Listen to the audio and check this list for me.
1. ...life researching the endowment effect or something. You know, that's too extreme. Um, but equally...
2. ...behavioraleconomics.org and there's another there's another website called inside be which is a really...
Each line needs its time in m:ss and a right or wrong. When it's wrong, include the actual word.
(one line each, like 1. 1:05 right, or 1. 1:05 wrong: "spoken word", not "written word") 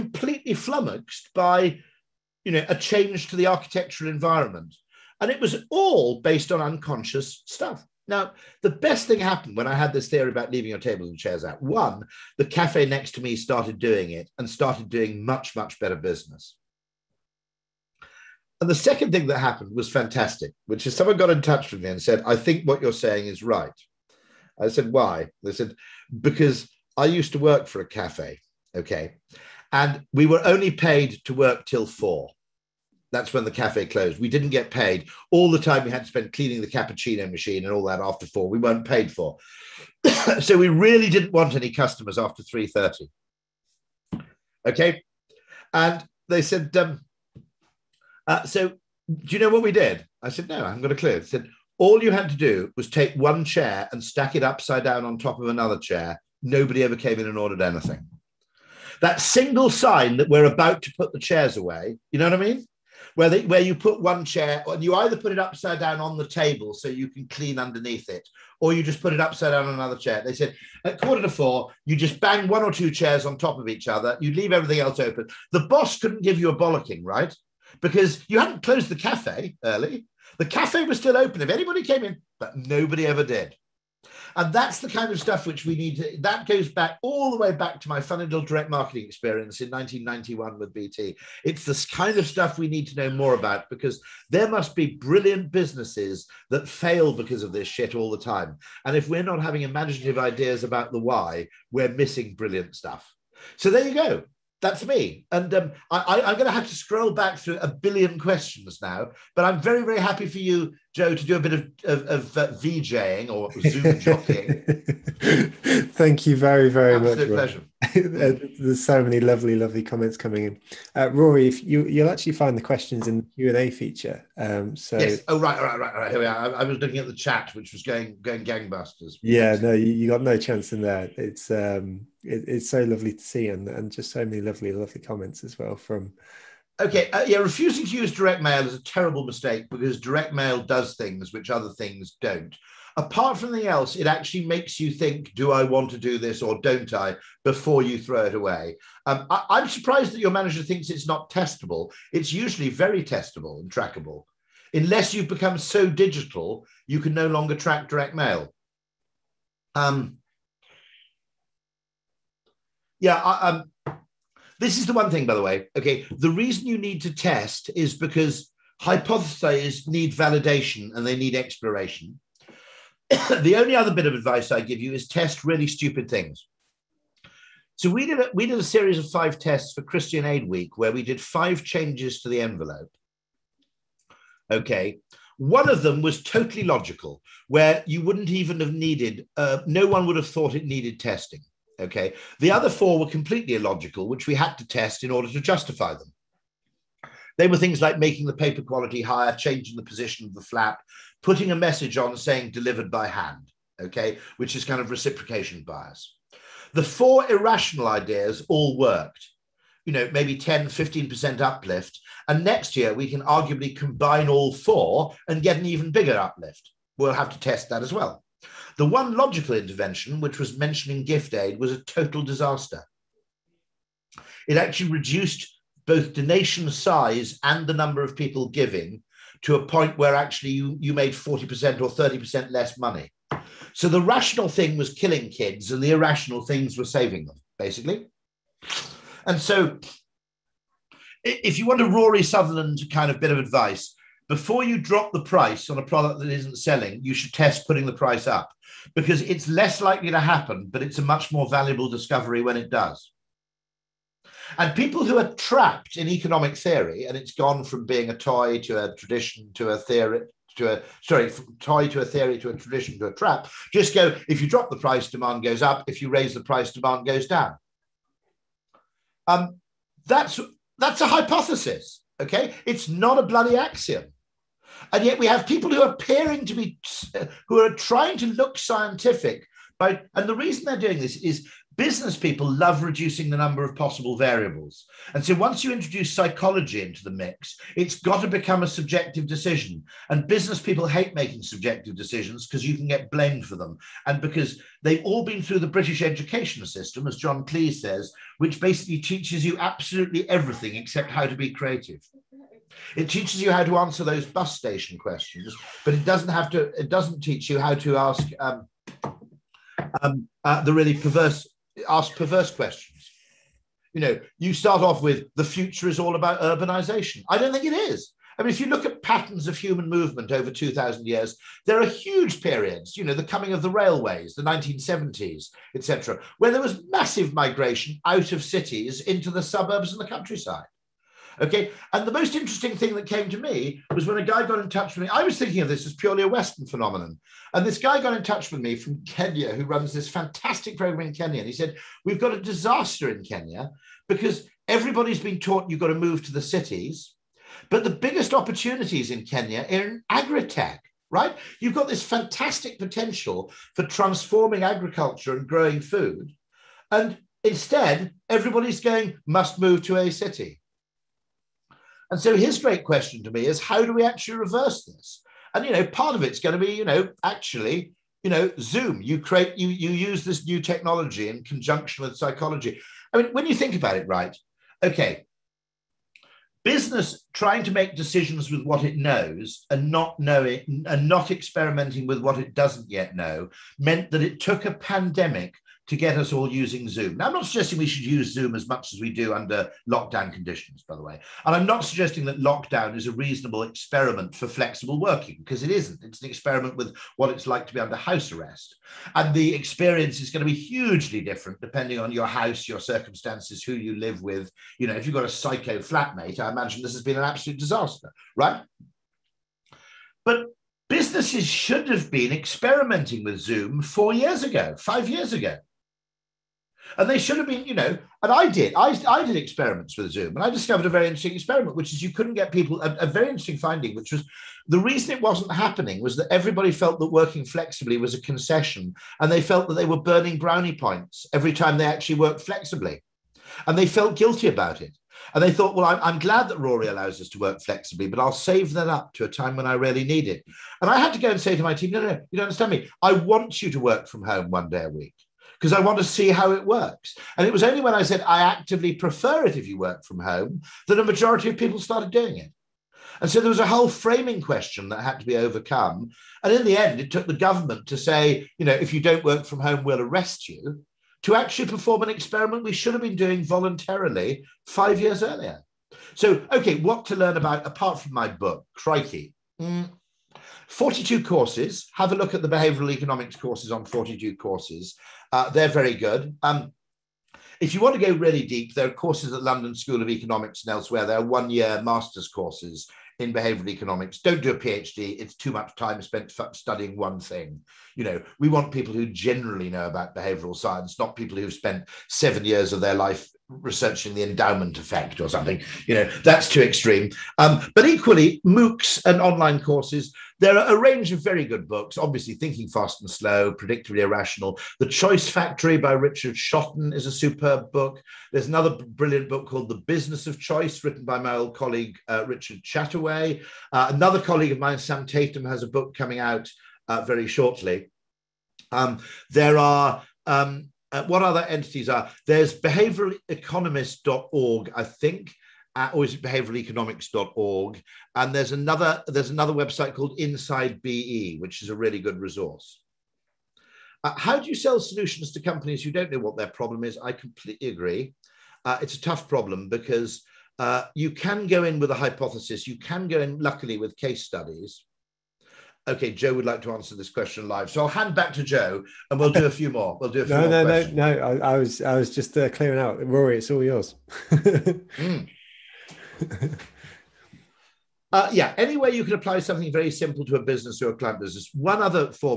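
1. 8:12 right
2. 8:46 right.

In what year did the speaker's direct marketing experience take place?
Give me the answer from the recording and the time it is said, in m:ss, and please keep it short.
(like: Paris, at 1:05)
1991, at 1:29.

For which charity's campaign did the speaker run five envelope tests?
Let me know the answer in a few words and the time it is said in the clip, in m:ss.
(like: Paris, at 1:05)
Christian Aid Week, at 2:59.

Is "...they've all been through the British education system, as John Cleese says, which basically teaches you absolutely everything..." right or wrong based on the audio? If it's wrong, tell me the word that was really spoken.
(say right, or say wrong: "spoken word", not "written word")
right.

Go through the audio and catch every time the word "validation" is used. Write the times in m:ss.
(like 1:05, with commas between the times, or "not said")
2:50.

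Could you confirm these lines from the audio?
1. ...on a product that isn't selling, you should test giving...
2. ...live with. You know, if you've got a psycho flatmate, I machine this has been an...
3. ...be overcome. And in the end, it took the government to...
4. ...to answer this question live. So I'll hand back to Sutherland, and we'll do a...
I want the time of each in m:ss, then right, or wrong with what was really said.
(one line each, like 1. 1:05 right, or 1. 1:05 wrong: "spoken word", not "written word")
1. 4:05 wrong: "putting", not "giving"
2. 6:43 wrong: "imagine", not "machine"
3. 7:35 right
4. 9:06 wrong: "Joe", not "Sutherland".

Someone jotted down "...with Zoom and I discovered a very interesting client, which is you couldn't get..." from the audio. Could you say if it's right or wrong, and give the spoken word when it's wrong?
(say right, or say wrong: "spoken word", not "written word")
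wrong: "experiment", not "client".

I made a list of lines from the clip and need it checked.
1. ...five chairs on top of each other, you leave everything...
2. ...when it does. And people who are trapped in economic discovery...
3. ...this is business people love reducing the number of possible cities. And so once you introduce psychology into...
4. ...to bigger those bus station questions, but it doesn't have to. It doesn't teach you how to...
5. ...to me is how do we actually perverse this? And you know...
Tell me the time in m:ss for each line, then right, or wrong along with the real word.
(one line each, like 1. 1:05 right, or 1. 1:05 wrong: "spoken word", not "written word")
1. 1:12 wrong: "two", not "five"
2. 4:12 wrong: "theory", not "discovery"
3. 4:40 wrong: "variables", not "cities"
4. 5:03 wrong: "answer", not "bigger"
5. 6:03 wrong: "reverse", not "perverse".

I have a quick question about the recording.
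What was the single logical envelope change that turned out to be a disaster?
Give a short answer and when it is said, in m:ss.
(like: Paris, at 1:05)
mentioning gift aid, at 3:40.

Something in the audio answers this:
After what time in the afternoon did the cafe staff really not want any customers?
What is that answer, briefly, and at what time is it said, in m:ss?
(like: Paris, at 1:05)
3.30, at 0:42.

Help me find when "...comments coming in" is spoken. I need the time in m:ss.
1:59.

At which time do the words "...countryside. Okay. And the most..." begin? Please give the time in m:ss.
5:30.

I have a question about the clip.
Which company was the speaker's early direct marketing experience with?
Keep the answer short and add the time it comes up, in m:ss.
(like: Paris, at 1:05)
BT, at 1:30.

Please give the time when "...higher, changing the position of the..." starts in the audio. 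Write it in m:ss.
3:19.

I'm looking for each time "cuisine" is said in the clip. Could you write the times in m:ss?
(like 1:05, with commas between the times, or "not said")
not said.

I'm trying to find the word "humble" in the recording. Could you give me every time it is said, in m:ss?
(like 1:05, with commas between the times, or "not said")
not said.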